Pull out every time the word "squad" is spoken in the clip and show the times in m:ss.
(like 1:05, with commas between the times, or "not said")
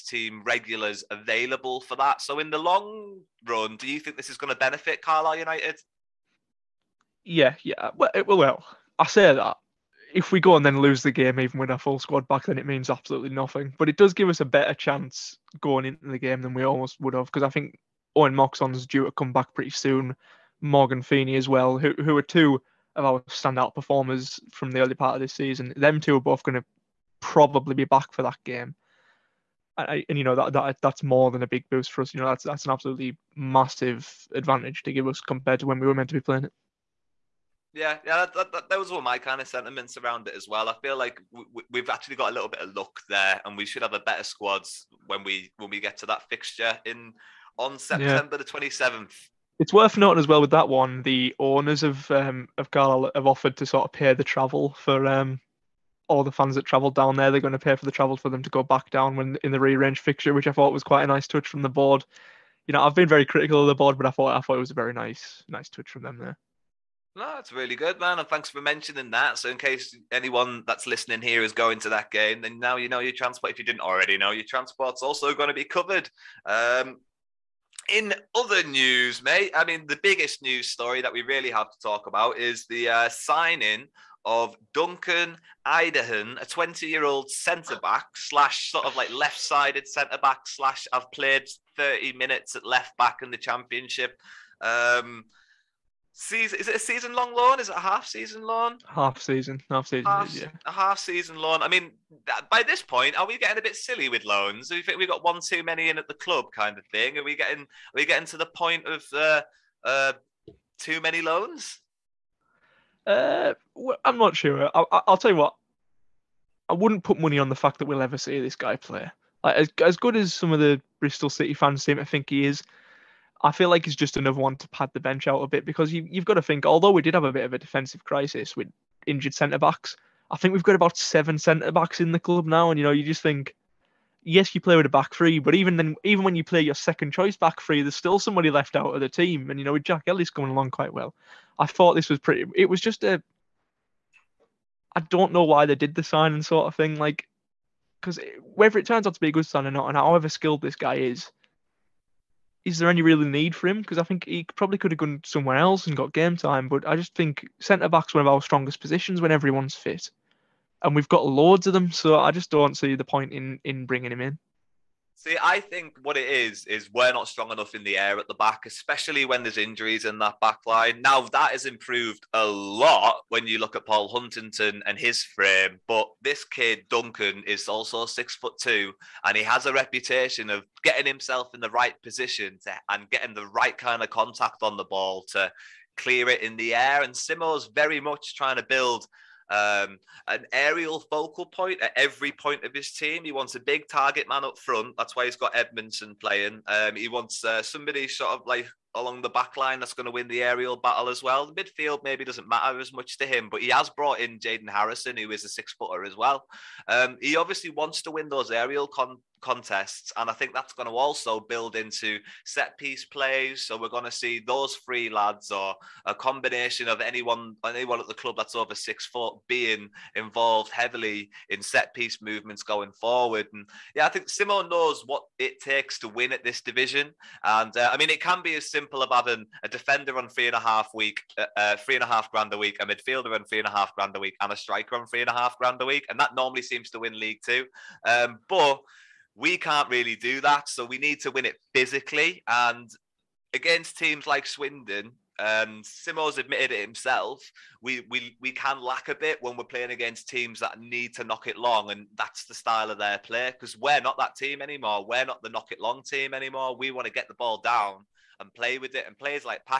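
0:11, 0:44.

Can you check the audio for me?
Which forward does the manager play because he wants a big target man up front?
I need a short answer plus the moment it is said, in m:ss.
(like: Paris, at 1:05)
Edmondson, at 3:15.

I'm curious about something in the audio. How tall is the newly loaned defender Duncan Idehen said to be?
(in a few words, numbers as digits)
6 foot 2.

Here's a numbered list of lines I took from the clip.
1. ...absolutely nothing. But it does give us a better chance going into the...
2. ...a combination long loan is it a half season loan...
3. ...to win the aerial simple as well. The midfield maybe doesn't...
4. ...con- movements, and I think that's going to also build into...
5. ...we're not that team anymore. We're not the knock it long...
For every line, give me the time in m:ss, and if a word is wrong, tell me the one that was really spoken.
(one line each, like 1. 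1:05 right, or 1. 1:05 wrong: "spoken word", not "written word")
1. 0:12 right
2. 1:36 wrong: "season", not "combination"
3. 3:20 wrong: "battle", not "simple"
4. 3:28 wrong: "contests", not "movements"
5. 4:13 right.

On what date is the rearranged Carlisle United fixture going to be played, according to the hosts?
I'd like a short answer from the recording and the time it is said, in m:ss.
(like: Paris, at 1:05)
September 27th, at 0:48.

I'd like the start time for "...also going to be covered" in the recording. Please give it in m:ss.
1:15.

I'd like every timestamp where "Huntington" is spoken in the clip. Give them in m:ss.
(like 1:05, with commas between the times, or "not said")
2:54.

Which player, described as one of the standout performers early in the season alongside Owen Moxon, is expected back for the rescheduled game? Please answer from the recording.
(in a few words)
Morgan Feeney.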